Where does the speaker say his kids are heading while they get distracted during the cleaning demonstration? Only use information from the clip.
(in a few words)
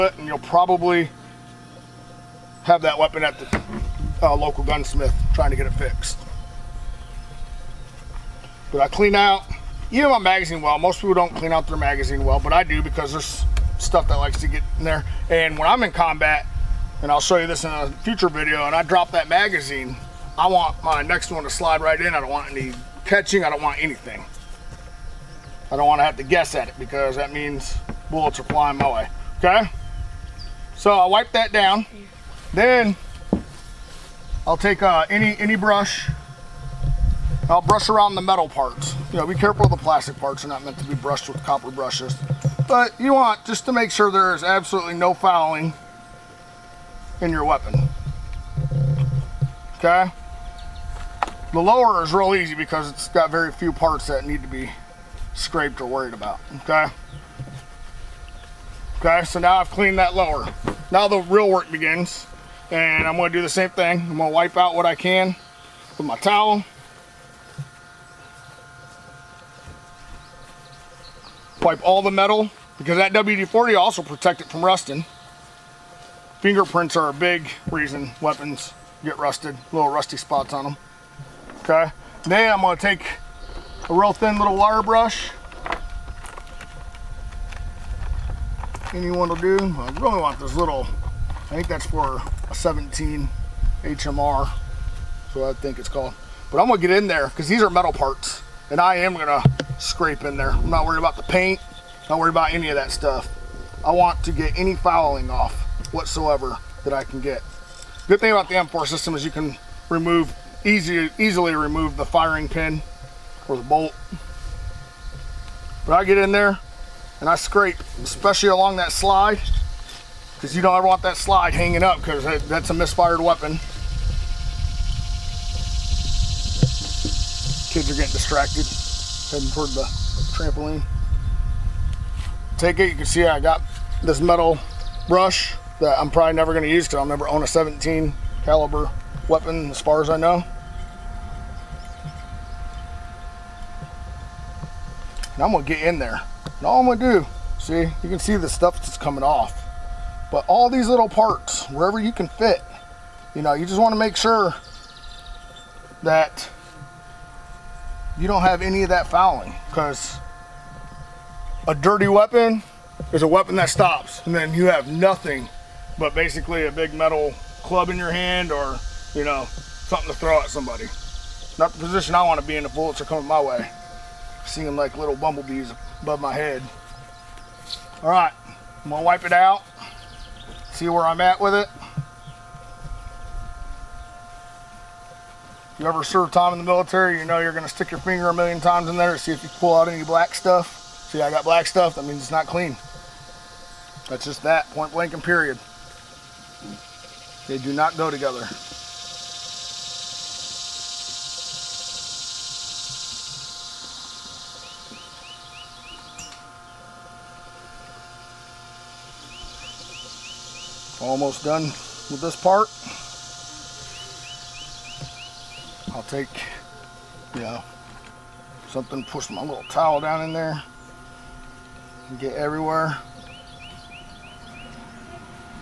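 the trampoline.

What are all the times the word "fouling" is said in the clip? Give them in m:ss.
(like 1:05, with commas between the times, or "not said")
0:45, 1:44, 2:39.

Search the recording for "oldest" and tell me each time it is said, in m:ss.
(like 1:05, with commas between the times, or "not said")
not said.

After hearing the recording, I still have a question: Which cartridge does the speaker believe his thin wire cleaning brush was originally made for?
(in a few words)
17 HMR.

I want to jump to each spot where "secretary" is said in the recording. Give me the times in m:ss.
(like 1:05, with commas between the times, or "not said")
not said.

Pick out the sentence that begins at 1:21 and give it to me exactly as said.
Okay, then I'm gonna take a real thin little wire brush.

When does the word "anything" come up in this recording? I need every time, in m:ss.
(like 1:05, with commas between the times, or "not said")
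0:23.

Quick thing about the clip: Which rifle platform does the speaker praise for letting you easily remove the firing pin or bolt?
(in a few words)
M4.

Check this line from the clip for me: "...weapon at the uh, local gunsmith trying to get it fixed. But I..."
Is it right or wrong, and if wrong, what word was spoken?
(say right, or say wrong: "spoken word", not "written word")
right.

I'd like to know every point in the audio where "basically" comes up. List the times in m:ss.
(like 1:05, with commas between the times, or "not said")
2:46.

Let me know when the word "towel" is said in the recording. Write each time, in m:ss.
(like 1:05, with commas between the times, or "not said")
1:06, 3:39.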